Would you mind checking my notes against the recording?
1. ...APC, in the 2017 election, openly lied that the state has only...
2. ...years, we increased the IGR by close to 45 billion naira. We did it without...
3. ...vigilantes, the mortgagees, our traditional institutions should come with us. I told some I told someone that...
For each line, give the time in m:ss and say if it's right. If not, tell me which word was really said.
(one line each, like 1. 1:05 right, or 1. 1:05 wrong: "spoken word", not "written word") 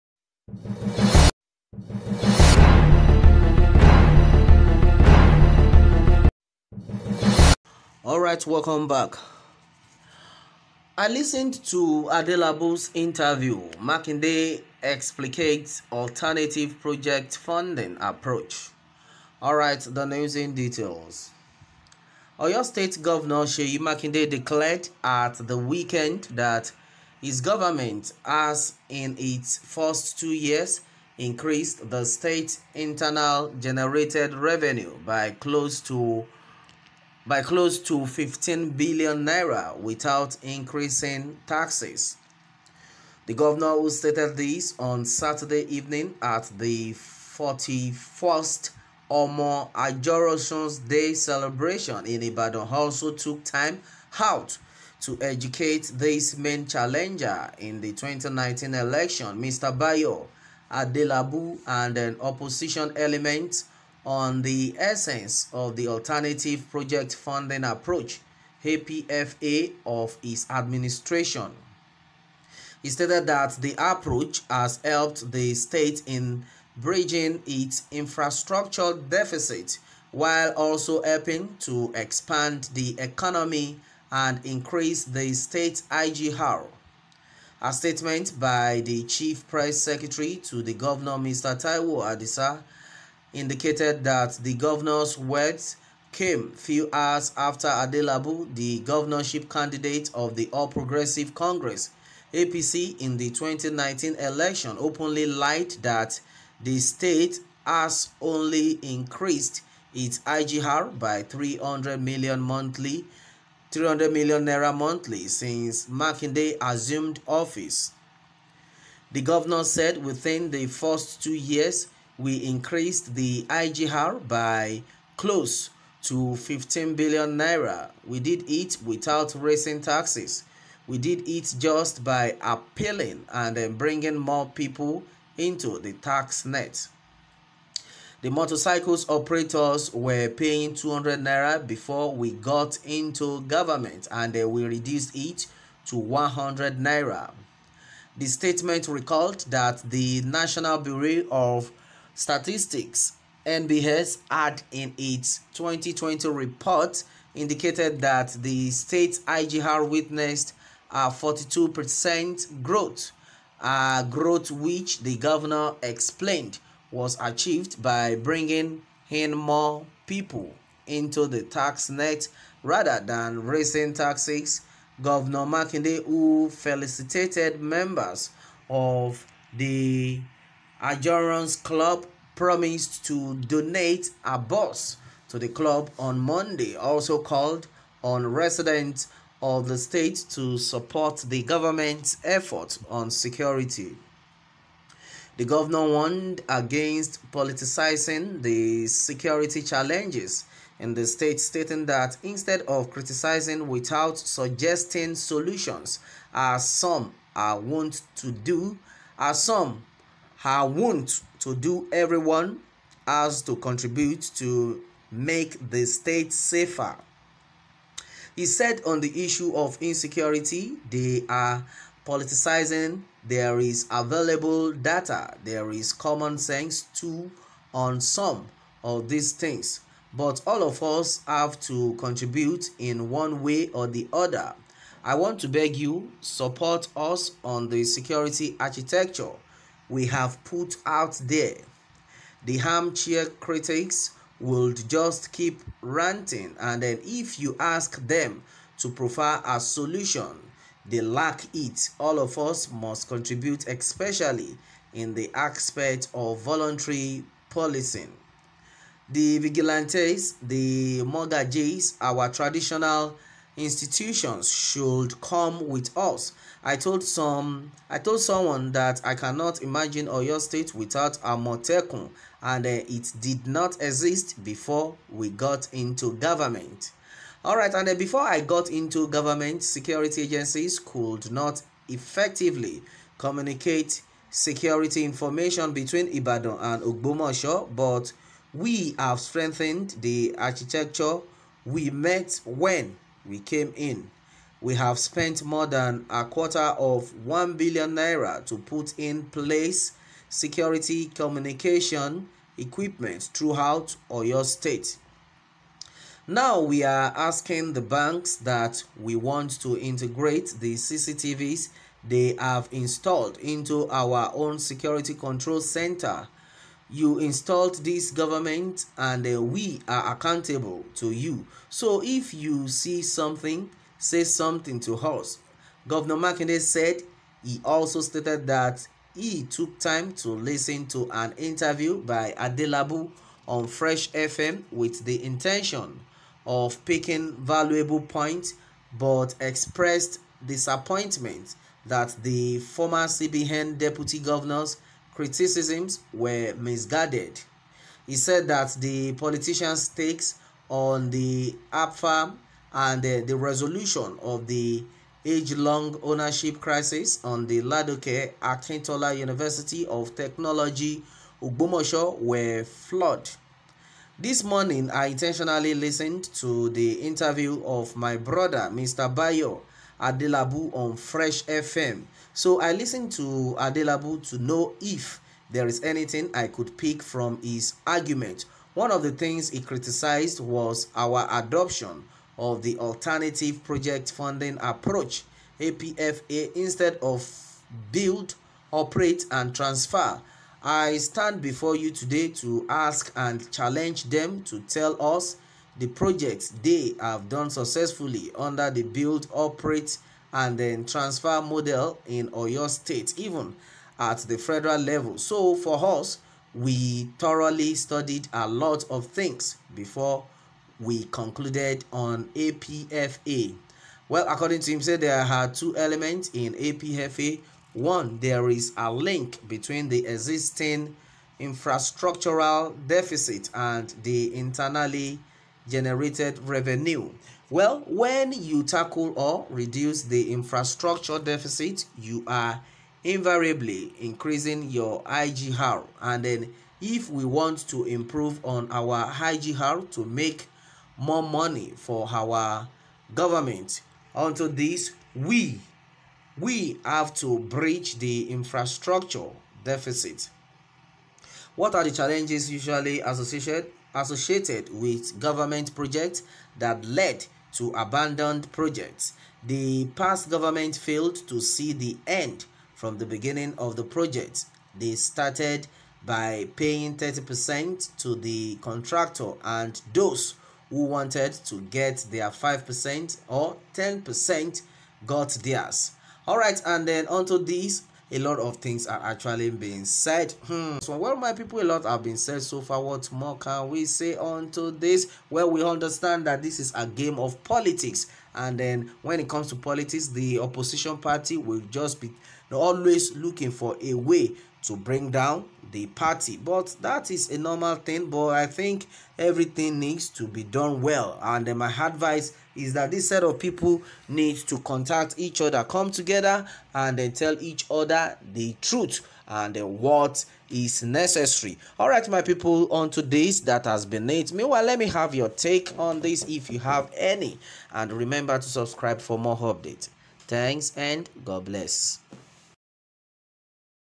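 1. 1:42 wrong: "2019", not "2017"
2. 2:01 wrong: "15", not "45"
3. 4:19 right.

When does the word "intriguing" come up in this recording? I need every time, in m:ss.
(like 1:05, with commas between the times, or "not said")
not said.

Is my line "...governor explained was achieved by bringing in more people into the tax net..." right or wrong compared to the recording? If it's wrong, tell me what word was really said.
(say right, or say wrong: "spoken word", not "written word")
right.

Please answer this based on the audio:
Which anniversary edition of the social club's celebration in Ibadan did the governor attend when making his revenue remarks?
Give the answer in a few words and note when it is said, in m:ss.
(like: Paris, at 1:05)
41st, at 0:46.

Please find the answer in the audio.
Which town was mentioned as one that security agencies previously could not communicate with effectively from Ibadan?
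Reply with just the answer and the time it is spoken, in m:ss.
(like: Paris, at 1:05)
Ogbomosho, at 4:46.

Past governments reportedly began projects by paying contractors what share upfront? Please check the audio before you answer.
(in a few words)
30%.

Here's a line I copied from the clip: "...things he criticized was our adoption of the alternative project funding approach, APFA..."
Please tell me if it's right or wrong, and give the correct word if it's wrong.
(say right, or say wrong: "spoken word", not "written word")
right.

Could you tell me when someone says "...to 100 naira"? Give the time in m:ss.
2:25.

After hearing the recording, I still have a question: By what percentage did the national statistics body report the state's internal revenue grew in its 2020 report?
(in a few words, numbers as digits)
42%.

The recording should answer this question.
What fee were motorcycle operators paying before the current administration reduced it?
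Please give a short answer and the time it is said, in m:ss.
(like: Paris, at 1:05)
200 naira, at 2:20.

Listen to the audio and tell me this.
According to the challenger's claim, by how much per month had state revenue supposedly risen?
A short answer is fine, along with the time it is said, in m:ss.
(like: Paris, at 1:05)
300 million naira, at 1:53.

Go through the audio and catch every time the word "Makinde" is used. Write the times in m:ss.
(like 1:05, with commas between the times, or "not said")
0:13, 0:23, 1:55, 2:55, 5:26.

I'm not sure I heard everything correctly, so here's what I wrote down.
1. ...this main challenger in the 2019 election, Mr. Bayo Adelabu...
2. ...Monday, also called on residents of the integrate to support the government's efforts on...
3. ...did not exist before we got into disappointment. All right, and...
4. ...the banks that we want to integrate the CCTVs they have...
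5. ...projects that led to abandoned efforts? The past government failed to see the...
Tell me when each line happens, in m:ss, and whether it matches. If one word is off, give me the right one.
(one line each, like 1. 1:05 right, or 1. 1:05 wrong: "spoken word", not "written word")
1. 0:55 right
2. 3:06 wrong: "state", not "integrate"
3. 4:33 wrong: "government", not "disappointment"
4. 5:07 right
5. 7:35 wrong: "projects", not "efforts".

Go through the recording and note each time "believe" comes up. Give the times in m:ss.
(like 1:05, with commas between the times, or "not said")
not said.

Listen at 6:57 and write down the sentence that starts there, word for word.
One, there is a link between the existing infrastructural deficit and the internally generated revenue.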